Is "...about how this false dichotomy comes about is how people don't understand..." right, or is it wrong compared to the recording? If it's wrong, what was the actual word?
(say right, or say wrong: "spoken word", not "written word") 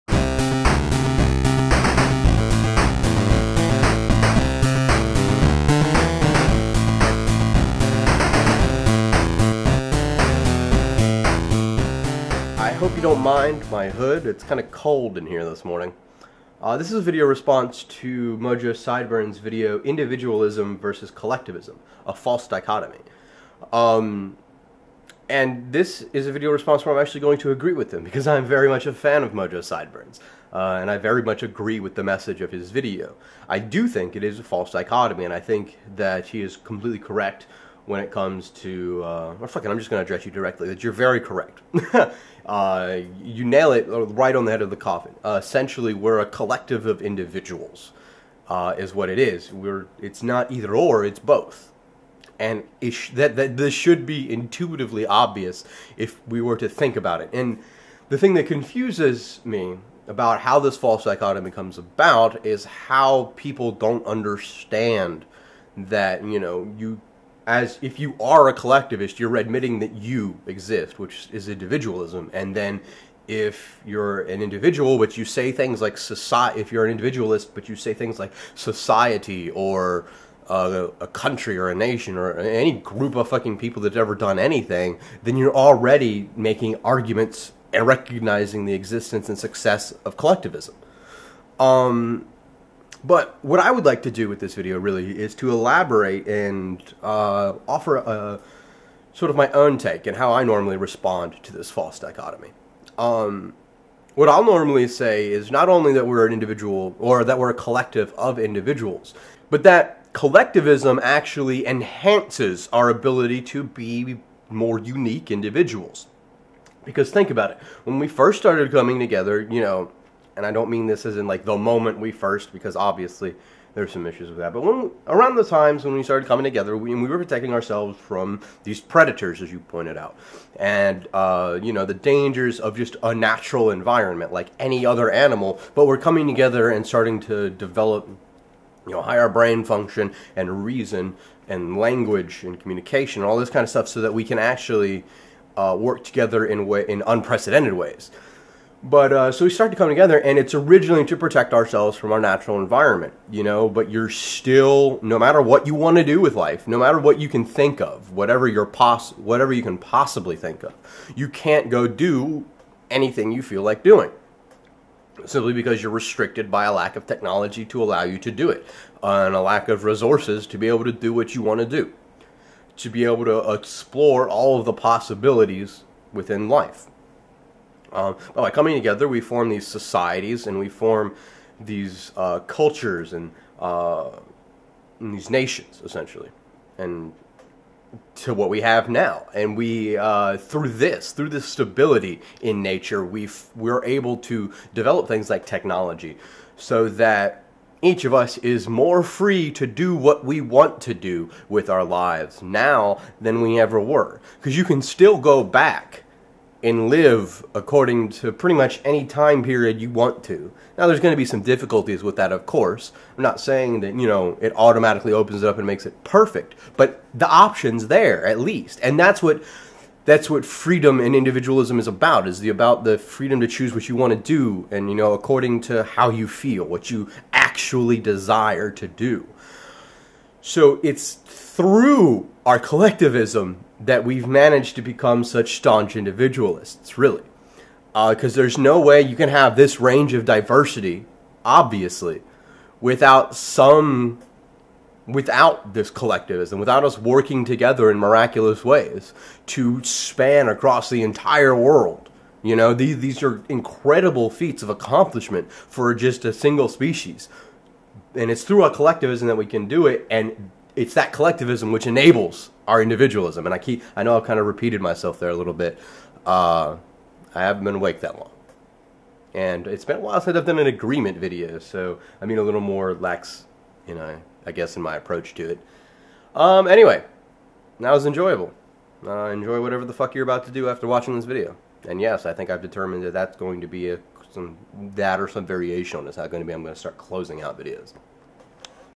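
right.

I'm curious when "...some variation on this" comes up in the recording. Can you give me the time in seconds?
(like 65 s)
285 s.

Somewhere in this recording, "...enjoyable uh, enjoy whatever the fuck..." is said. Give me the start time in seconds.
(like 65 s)
278 s.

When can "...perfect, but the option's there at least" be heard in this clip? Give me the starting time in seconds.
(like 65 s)
216 s.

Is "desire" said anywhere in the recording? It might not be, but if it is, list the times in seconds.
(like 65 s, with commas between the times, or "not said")
227 s.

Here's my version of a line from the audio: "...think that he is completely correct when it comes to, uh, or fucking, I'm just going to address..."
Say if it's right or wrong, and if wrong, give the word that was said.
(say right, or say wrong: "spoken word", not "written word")
right.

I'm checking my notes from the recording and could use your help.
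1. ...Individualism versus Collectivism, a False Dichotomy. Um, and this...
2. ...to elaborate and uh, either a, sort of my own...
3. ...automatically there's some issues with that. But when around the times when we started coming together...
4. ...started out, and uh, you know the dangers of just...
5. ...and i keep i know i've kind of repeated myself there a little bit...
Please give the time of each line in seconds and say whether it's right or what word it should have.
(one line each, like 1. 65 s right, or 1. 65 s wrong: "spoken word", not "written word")
1. 19 s right
2. 95 s wrong: "offer", not "either"
3. 122 s wrong: "obviously", not "automatically"
4. 129 s wrong: "pointed", not "started"
5. 263 s right.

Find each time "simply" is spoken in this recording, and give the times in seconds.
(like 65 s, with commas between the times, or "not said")
165 s.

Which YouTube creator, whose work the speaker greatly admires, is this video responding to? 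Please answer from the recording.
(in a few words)
Mojo Sideburns.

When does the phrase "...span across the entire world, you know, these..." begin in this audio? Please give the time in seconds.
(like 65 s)
249 s.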